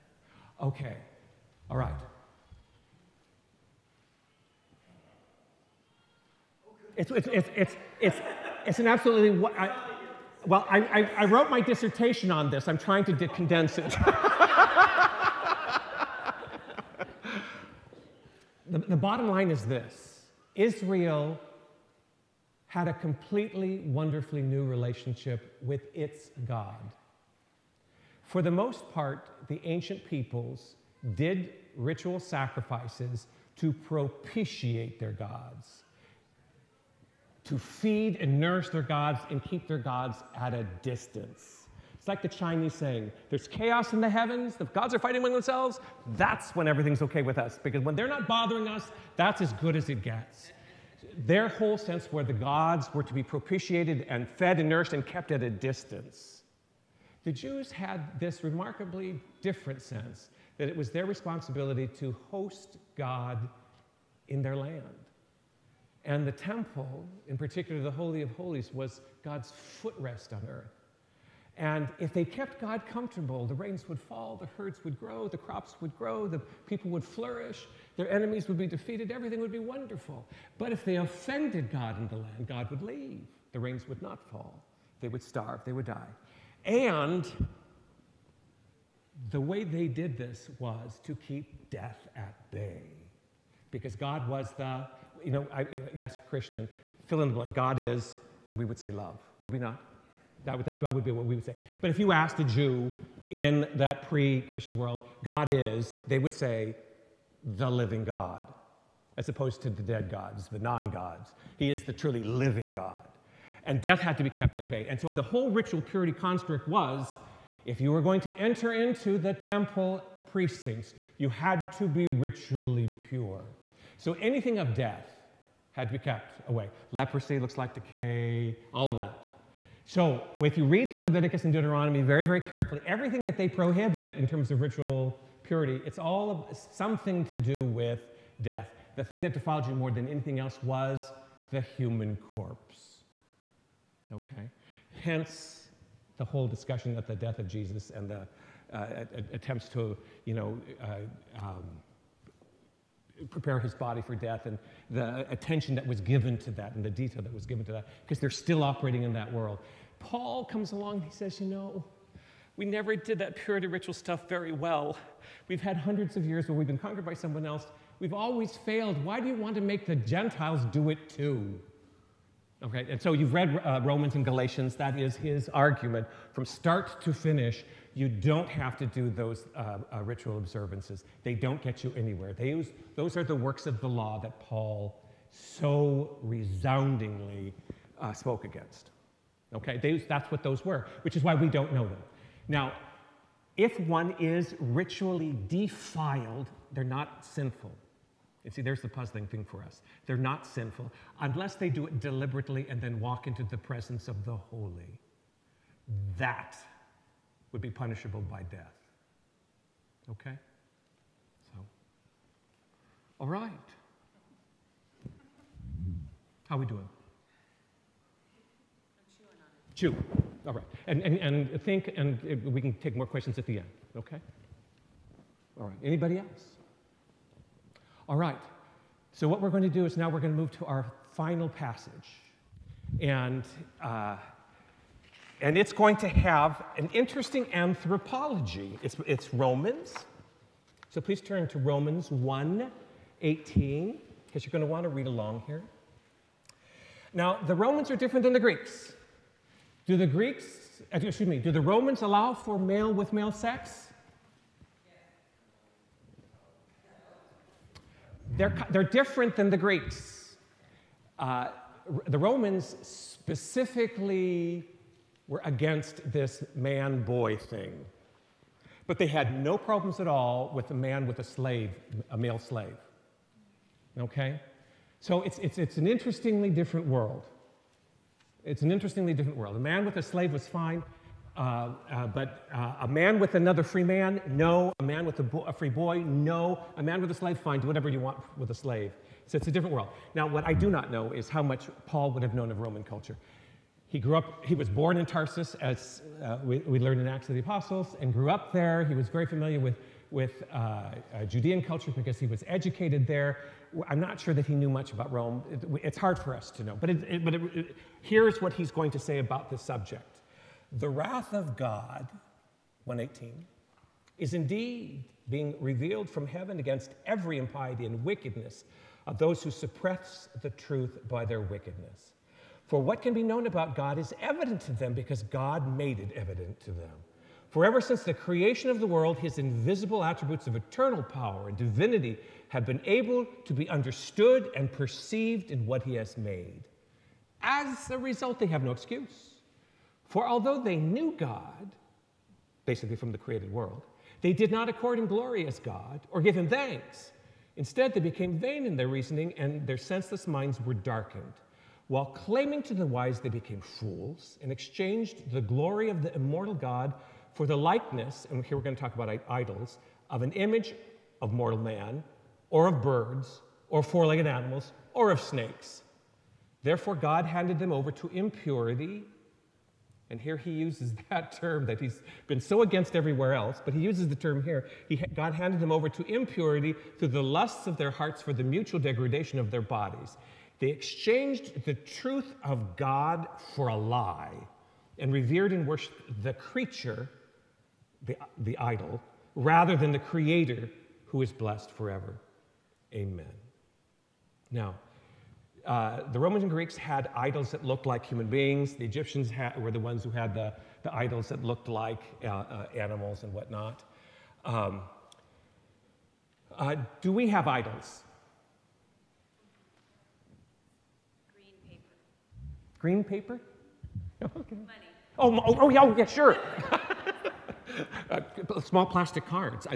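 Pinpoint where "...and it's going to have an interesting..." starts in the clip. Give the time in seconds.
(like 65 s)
235 s.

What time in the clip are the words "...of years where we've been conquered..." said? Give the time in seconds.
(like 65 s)
166 s.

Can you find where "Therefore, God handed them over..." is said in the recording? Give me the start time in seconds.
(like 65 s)
366 s.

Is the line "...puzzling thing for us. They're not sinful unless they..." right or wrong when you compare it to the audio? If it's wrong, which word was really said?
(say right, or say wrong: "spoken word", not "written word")
right.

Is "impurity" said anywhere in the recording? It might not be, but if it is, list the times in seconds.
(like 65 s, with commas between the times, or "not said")
368 s, 376 s.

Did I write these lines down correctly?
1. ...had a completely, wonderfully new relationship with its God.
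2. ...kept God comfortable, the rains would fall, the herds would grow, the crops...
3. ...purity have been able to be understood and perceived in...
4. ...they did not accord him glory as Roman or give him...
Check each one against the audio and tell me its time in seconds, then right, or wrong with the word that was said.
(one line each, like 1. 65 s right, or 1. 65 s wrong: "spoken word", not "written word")
1. 22 s right
2. 72 s right
3. 331 s wrong: "divinity", not "purity"
4. 344 s wrong: "God", not "Roman".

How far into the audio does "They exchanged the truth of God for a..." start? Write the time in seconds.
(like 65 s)
380 s.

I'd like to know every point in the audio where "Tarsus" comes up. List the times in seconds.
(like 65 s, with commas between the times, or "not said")
295 s.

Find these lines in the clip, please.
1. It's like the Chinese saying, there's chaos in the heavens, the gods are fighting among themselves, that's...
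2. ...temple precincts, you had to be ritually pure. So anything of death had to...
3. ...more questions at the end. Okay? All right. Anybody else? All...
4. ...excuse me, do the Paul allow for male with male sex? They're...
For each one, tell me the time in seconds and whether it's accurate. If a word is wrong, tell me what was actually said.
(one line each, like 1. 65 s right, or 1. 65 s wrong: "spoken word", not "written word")
1. 41 s right
2. 119 s right
3. 222 s right
4. 251 s wrong: "Romans", not "Paul".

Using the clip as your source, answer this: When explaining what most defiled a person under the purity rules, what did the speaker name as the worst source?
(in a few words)
the human corpse.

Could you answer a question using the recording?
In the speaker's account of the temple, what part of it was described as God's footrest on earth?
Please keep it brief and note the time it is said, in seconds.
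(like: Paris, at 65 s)
Holy of Holies, at 67 s.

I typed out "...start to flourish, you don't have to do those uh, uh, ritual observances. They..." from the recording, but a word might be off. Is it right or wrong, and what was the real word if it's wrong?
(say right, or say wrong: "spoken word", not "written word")
wrong: "finish", not "flourish".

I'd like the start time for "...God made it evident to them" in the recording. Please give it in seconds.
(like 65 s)
325 s.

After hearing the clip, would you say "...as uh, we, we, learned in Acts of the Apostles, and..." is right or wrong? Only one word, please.
right.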